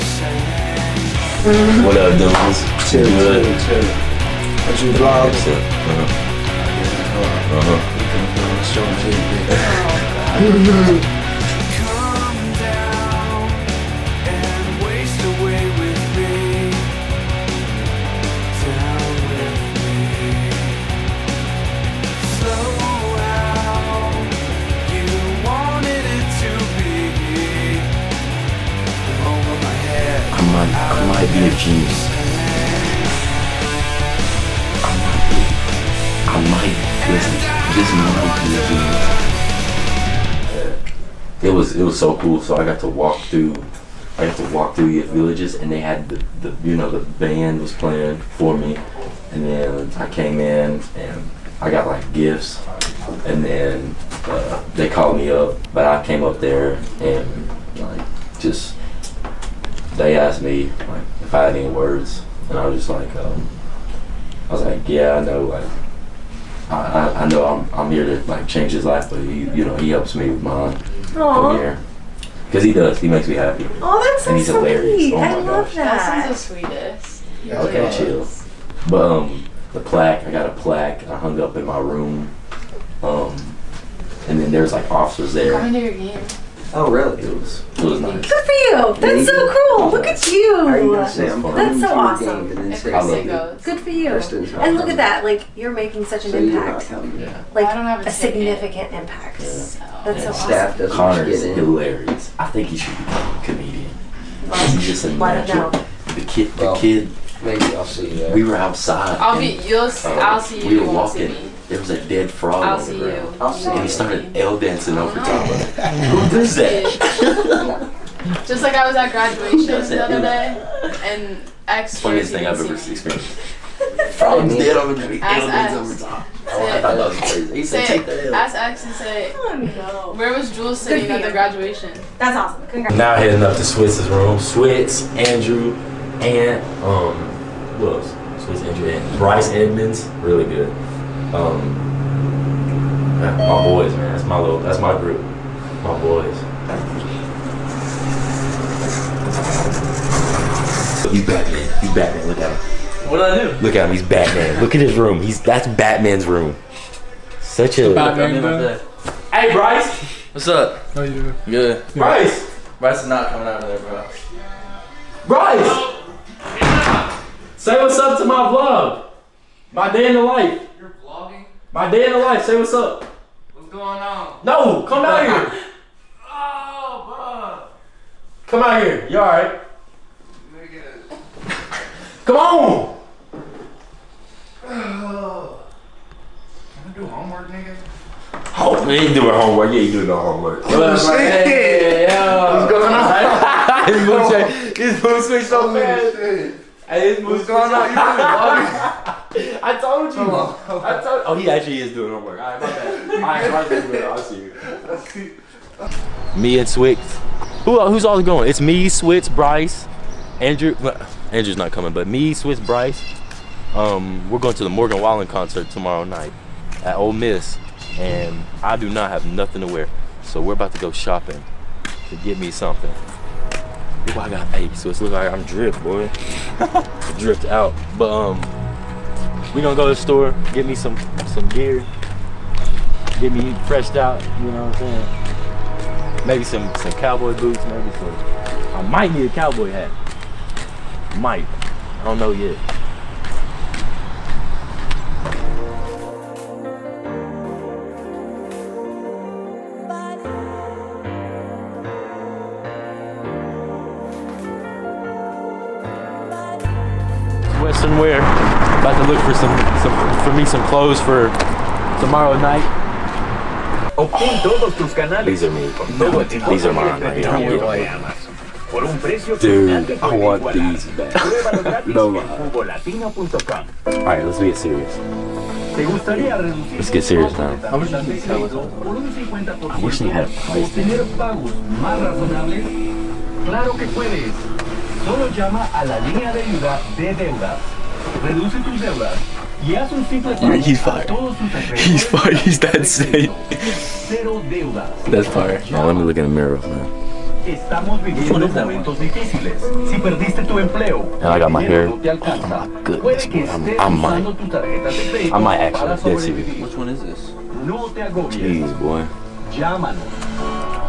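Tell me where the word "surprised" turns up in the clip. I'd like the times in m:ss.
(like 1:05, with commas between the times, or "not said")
not said.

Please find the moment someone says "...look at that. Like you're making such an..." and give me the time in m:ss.
1:34.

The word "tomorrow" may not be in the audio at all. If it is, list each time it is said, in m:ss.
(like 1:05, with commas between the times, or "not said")
3:35, 4:22.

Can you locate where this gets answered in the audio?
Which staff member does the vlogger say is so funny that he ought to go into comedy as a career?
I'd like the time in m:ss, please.
1:40.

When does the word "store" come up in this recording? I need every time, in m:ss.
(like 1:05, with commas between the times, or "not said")
3:49.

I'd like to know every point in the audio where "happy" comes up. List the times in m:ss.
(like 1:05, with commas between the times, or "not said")
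1:13.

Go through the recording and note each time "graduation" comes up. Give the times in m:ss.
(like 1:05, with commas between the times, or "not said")
1:59, 2:11.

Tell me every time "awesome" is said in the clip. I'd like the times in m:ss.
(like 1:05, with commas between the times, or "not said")
1:31, 1:40, 2:12.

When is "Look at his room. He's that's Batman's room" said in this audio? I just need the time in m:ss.
2:34.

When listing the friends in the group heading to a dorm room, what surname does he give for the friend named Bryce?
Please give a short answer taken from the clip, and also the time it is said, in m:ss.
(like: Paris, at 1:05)
Edmonds, at 2:19.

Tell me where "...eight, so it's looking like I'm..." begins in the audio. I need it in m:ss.
3:44.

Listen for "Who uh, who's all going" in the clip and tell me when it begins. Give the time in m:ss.
3:27.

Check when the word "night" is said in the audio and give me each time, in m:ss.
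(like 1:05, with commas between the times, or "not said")
3:36, 4:22.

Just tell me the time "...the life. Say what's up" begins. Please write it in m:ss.
2:52.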